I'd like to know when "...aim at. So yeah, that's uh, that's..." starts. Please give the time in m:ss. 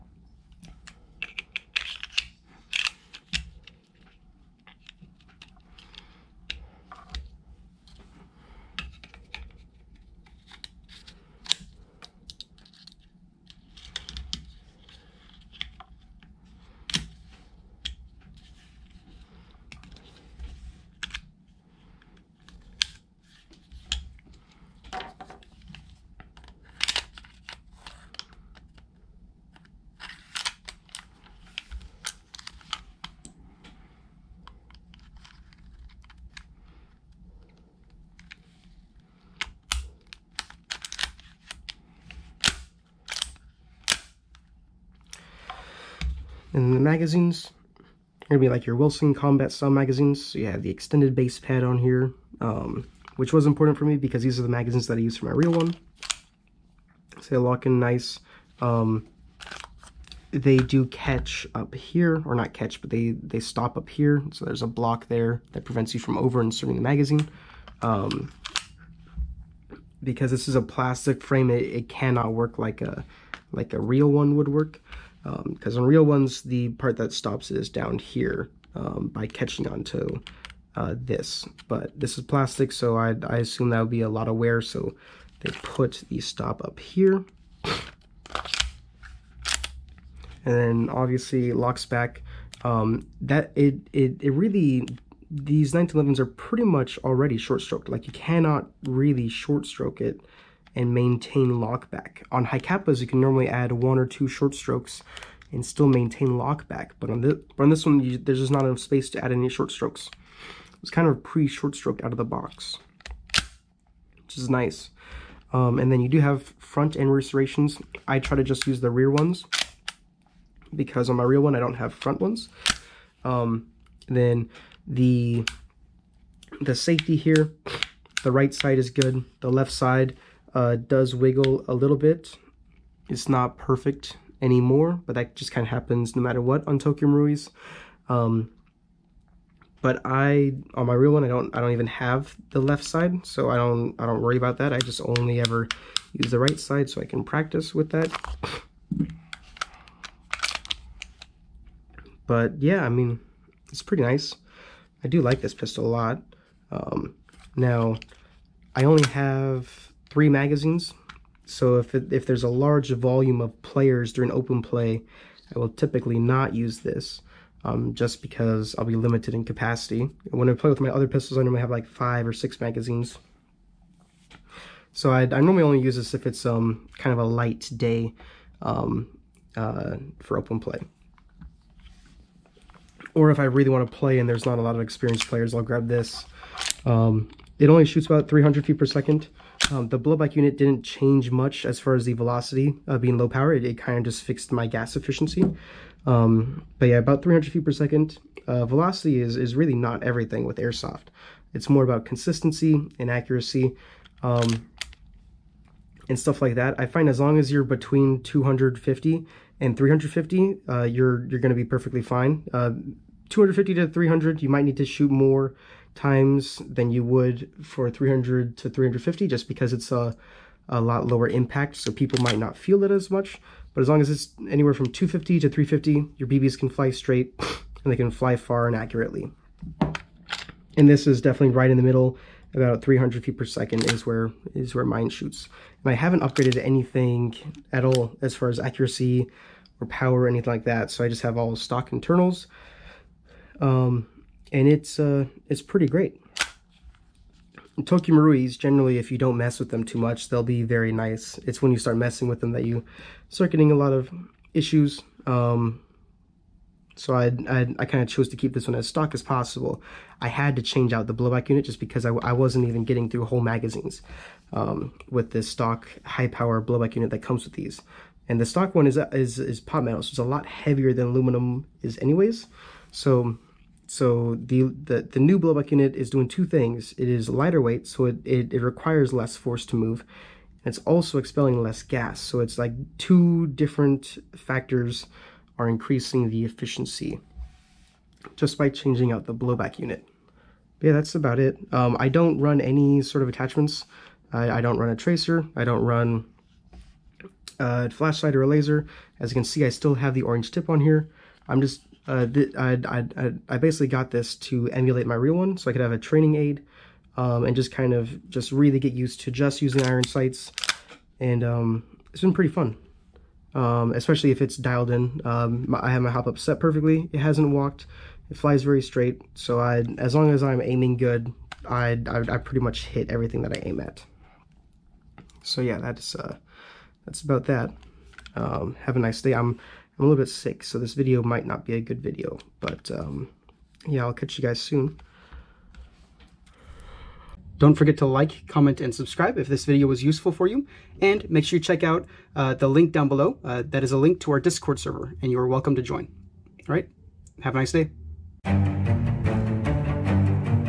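5:23.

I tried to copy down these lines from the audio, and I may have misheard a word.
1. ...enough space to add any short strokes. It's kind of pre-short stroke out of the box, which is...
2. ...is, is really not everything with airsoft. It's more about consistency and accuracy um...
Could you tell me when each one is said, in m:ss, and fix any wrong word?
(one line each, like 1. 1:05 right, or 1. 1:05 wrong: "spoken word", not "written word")
1. 1:48 right
2. 3:19 right.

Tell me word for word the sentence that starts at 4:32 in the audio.
So so the, the, the new blowback unit is doing two things.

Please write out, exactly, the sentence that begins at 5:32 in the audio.
But um, yeah, I'll catch you guys soon.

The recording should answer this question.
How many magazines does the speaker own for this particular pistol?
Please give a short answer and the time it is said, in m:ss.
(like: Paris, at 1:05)
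3, at 2:40.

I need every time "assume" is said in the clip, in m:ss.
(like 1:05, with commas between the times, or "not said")
1:23.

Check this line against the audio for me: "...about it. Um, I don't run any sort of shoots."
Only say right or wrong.
wrong.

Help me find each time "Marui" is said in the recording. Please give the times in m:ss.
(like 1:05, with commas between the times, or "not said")
2:17, 4:08.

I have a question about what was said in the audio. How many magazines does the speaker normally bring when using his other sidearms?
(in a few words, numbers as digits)
5 or 6.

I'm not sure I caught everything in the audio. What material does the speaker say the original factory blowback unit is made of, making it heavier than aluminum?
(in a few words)
pot metal.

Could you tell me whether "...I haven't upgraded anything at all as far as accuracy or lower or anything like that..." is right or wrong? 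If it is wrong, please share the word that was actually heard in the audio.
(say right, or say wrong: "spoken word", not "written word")
wrong: "power", not "lower".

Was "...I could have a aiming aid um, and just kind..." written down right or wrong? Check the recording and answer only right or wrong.
wrong.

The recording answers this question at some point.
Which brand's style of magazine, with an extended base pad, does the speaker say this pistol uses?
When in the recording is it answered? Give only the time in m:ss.
0:48.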